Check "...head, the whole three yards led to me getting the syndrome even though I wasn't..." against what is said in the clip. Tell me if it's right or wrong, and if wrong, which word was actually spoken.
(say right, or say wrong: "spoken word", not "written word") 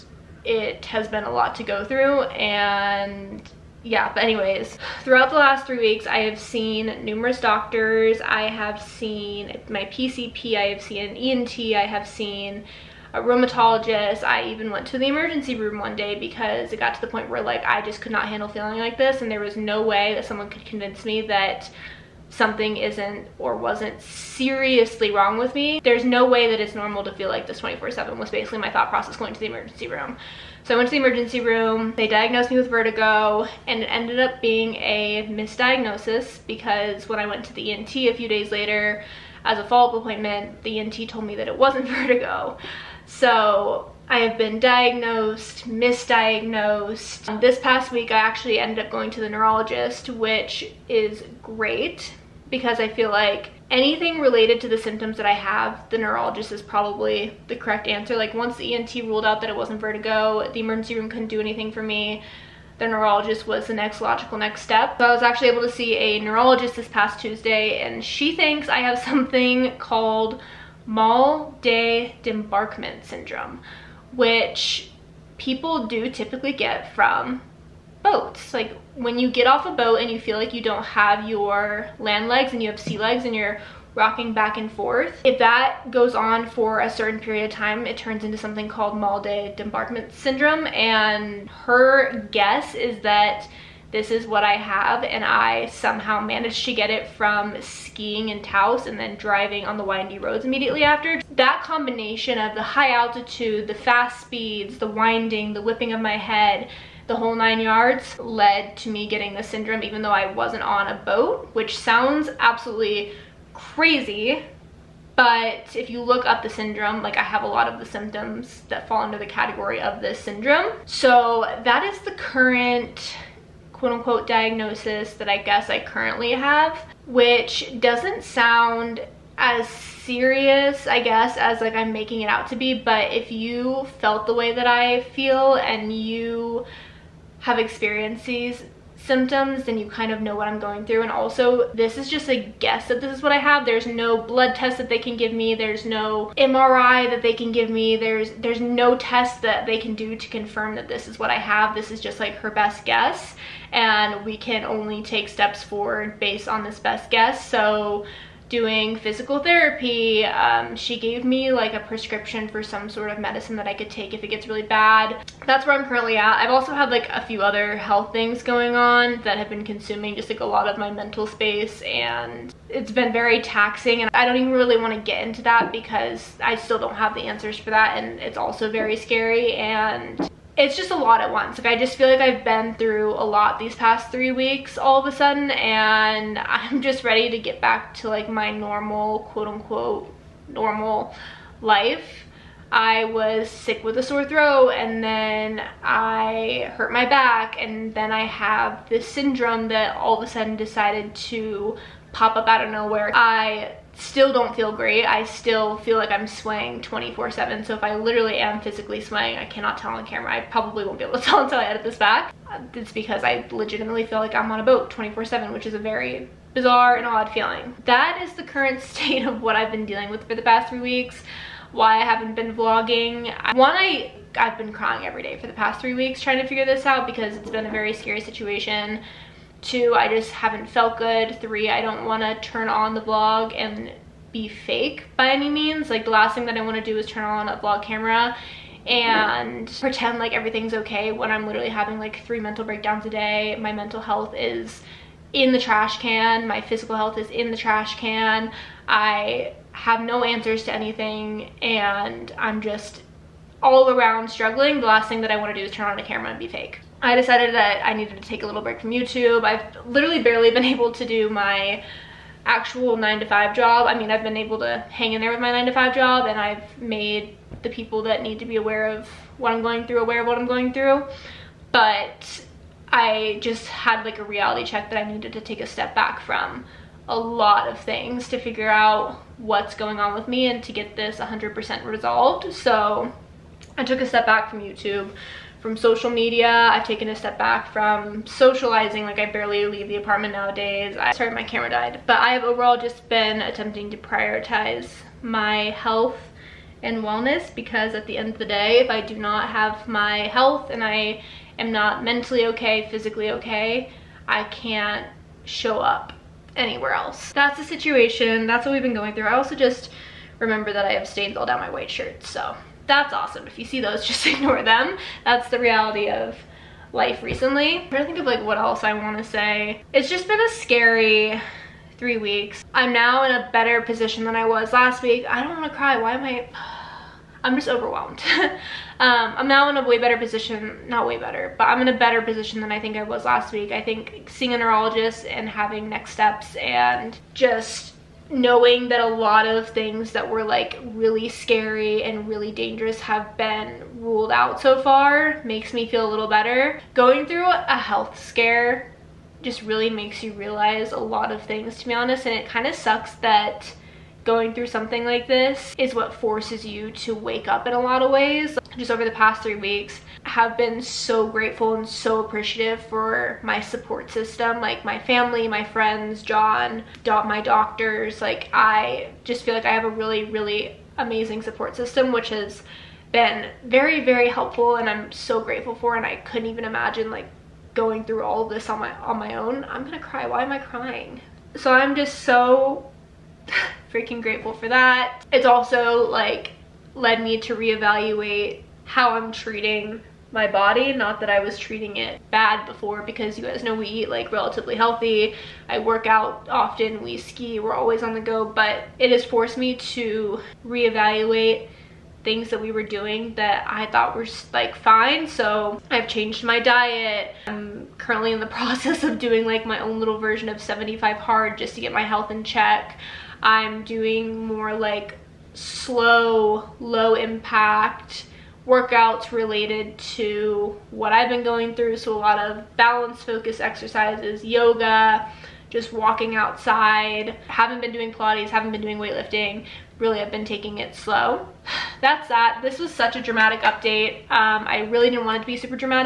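wrong: "nine", not "three".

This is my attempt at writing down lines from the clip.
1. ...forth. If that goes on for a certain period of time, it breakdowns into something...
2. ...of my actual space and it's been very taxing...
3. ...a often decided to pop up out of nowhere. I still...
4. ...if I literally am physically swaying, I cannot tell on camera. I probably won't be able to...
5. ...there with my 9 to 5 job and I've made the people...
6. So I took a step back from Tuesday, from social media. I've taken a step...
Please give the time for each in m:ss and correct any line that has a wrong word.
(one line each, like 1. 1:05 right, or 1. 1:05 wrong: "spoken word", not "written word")
1. 1:24 wrong: "turns", not "breakdowns"
2. 2:50 wrong: "mental", not "actual"
3. 3:20 wrong: "sudden", not "often"
4. 3:27 right
5. 4:25 right
6. 4:42 wrong: "YouTube", not "Tuesday".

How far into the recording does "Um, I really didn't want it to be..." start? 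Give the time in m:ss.
7:14.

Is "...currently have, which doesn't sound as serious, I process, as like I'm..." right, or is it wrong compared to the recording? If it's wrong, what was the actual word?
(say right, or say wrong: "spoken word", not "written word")
wrong: "guess", not "process".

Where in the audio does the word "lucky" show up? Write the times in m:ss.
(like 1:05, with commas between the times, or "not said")
not said.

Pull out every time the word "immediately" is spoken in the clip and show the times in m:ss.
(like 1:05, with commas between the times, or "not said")
1:40.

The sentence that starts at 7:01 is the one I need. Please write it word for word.
So a lot of balance focus exercises, yoga, just walking outside.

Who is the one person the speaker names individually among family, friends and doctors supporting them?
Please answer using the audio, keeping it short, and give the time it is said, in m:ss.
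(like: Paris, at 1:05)
John, at 6:06.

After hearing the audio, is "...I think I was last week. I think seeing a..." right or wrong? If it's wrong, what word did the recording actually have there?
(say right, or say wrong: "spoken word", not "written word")
right.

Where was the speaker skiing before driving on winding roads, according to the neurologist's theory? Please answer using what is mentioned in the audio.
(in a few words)
Taos.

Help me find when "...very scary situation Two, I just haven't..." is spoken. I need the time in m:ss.
3:47.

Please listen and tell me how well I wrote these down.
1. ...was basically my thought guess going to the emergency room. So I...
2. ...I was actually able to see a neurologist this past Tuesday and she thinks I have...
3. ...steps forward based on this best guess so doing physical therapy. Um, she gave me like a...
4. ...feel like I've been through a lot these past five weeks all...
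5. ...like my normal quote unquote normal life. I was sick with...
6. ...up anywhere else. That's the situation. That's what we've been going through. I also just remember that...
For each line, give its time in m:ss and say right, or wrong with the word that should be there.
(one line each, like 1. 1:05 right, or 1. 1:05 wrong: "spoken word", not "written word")
1. 0:28 wrong: "process", not "guess"
2. 1:05 right
3. 2:35 right
4. 3:01 wrong: "three", not "five"
5. 3:08 right
6. 5:05 right.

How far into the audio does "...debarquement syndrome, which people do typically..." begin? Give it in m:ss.
1:12.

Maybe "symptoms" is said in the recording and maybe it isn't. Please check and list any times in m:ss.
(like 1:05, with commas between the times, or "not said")
0:54, 1:57, 2:18.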